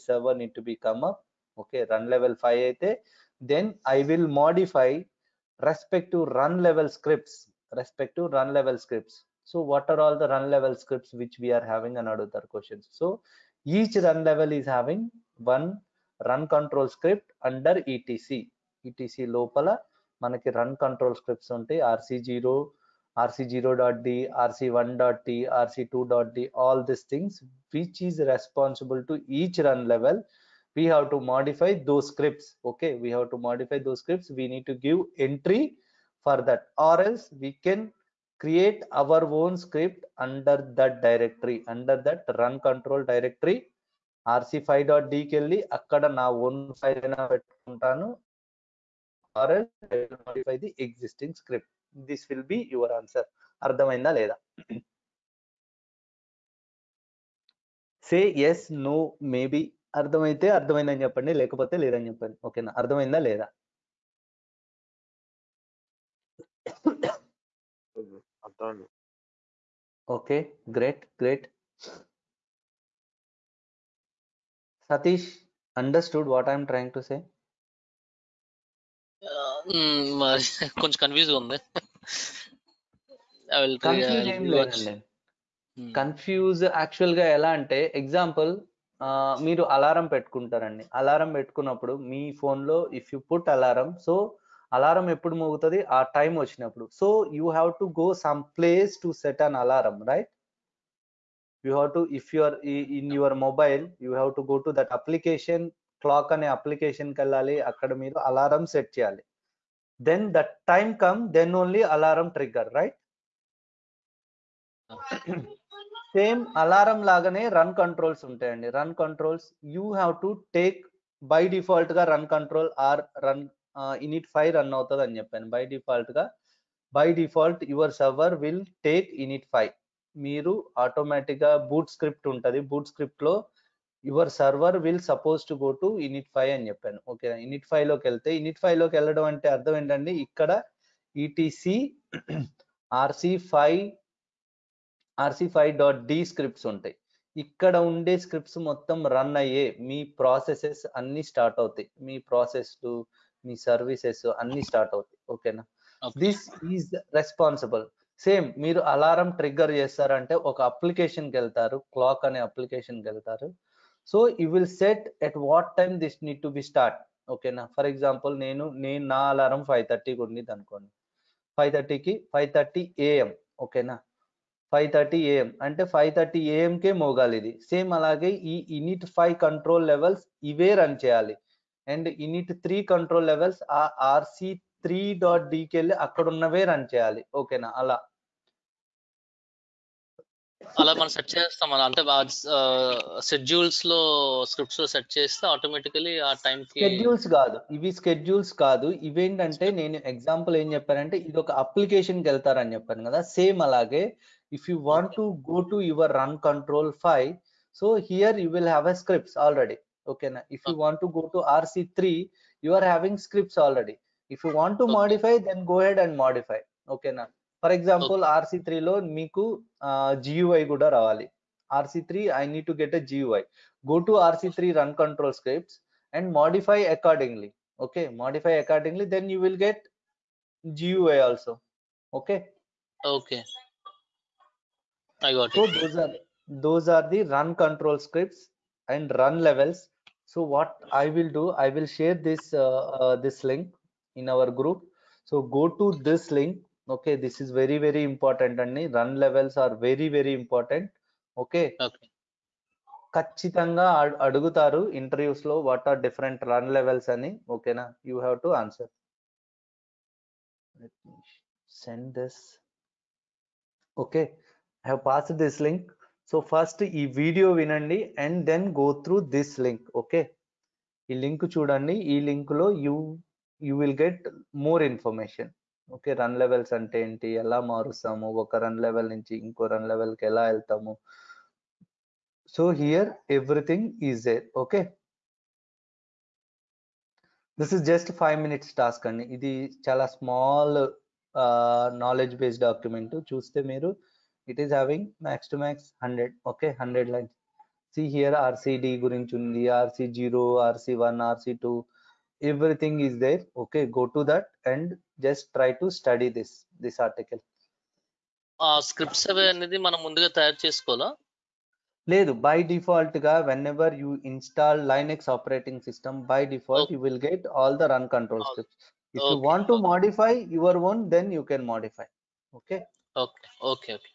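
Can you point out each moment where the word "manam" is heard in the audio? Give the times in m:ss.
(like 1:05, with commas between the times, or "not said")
5:09.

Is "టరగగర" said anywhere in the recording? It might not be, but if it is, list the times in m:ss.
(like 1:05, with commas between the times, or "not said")
1:52, 2:39.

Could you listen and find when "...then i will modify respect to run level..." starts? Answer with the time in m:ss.
0:03.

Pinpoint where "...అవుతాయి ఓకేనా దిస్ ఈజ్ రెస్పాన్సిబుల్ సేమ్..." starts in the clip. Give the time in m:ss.
2:34.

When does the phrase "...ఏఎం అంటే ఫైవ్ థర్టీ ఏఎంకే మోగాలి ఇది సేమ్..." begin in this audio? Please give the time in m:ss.
2:55.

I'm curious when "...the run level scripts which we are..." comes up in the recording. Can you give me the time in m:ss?
0:10.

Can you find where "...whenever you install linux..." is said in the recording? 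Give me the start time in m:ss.
5:13.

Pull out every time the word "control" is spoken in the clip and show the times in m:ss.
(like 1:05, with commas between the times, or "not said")
0:16, 3:44, 3:57, 5:18.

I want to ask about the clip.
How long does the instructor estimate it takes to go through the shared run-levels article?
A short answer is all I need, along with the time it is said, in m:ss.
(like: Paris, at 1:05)
5 minutes, at 4:48.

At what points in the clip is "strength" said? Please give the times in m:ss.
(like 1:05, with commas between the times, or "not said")
not said.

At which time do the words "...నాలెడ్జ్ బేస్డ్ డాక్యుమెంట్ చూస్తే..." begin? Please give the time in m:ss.
4:52.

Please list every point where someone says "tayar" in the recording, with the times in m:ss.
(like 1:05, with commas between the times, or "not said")
5:10.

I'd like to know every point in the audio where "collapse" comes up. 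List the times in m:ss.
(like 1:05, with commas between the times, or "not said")
not said.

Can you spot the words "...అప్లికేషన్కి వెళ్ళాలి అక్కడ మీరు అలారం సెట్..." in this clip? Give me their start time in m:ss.
1:46.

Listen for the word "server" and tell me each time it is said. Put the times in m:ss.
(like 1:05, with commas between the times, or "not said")
0:00.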